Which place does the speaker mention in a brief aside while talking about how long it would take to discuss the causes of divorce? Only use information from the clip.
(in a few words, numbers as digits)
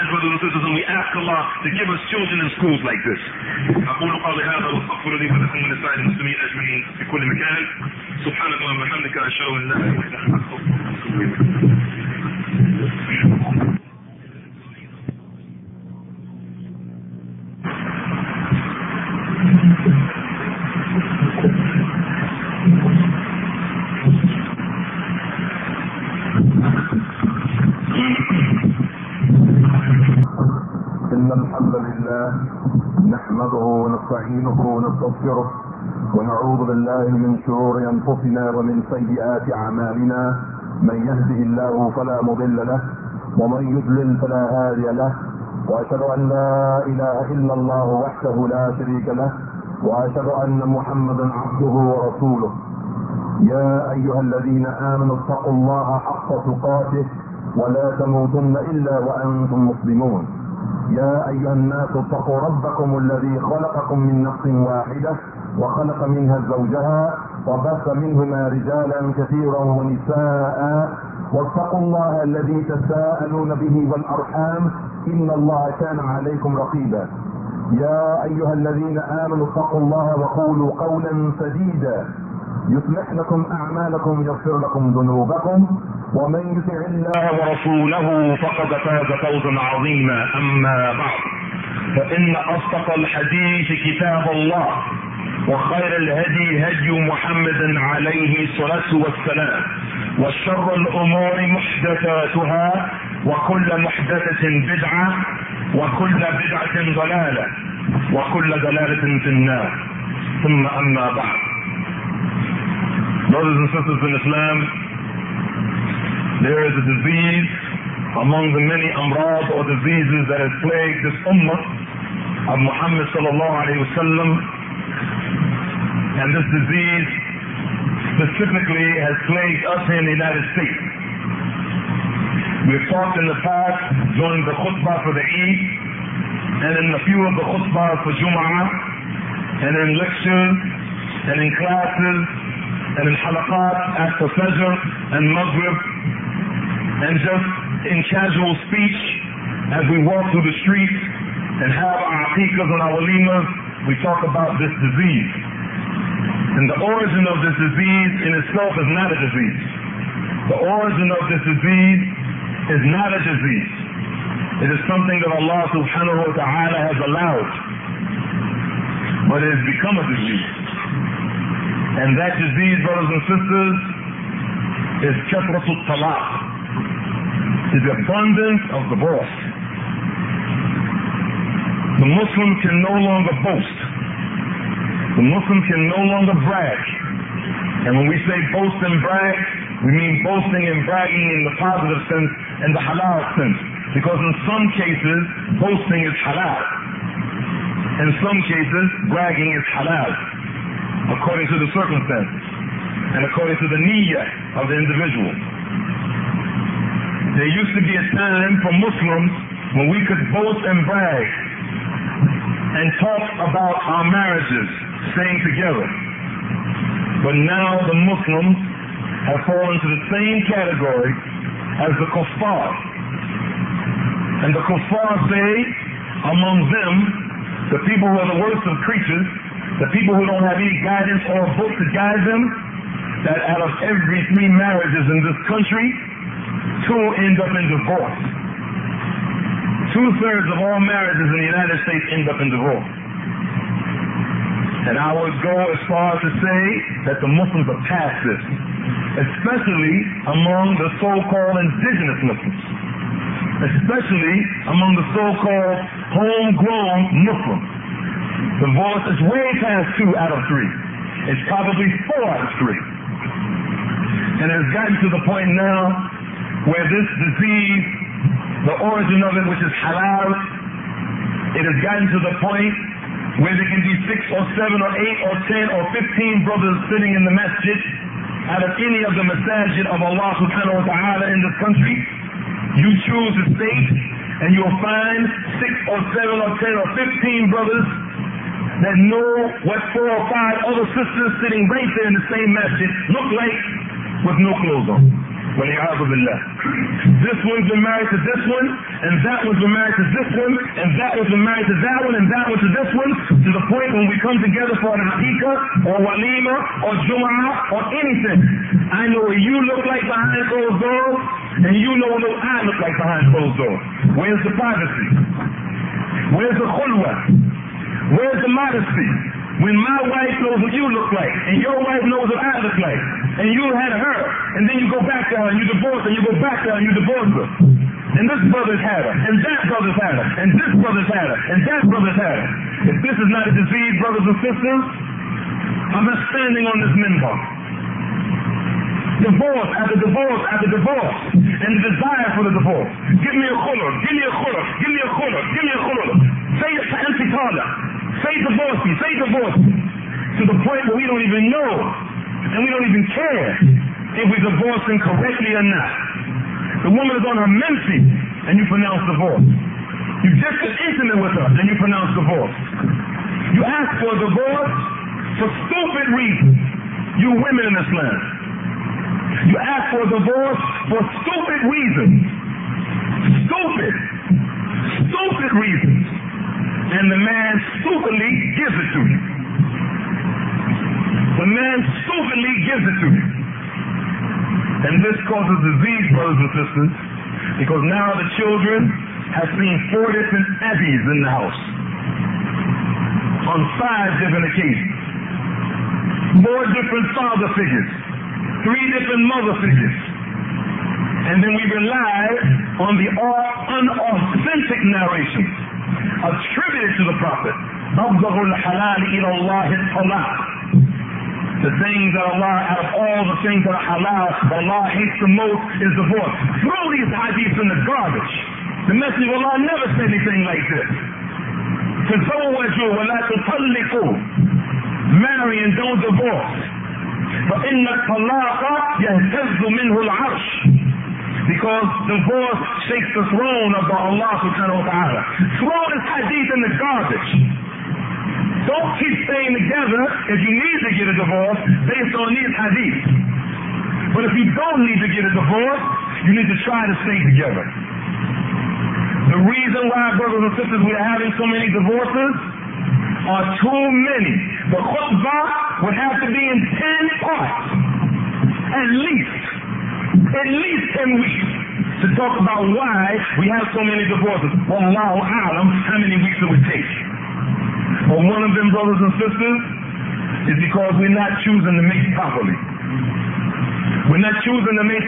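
Long Island.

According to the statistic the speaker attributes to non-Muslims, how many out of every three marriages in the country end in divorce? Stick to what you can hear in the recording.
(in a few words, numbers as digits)
2.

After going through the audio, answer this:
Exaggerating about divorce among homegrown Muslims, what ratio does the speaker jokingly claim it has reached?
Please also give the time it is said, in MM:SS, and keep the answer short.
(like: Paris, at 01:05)
4 out of 3, at 04:22.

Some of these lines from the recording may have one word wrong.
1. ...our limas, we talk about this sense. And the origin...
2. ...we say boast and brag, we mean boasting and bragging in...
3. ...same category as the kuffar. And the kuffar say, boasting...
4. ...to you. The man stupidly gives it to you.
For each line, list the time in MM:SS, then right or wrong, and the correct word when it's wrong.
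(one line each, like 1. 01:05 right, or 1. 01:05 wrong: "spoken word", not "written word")
1. 02:32 wrong: "disease", not "sense"
2. 03:08 right
3. 03:40 wrong: "among", not "boasting"
4. 06:18 right.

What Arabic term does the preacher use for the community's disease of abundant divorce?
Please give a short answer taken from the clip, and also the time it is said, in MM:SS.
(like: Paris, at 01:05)
katratul talaq, at 02:55.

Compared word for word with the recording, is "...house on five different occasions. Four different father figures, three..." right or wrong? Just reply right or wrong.
right.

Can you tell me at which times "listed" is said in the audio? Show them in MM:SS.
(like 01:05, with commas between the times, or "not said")
not said.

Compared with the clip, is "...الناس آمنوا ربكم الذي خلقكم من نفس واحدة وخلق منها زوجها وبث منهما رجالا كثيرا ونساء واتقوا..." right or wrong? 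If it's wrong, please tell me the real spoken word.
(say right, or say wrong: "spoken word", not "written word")
wrong: "اتقوا", not "آمنوا".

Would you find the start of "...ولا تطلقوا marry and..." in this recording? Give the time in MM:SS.
07:02.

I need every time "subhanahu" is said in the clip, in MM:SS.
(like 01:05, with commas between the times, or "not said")
02:45, 04:40, 07:14.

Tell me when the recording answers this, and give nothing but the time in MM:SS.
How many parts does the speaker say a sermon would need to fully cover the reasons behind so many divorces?
07:37.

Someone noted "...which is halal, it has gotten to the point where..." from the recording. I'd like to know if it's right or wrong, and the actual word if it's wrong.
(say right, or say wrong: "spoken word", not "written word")
right.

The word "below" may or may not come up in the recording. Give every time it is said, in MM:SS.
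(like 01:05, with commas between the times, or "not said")
not said.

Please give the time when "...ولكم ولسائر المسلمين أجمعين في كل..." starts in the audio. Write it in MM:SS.
00:05.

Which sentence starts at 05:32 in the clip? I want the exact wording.
If this is not a disease, brothers and sisters, I'm not standing on this minbar.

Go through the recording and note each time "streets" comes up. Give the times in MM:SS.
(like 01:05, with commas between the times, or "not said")
02:30.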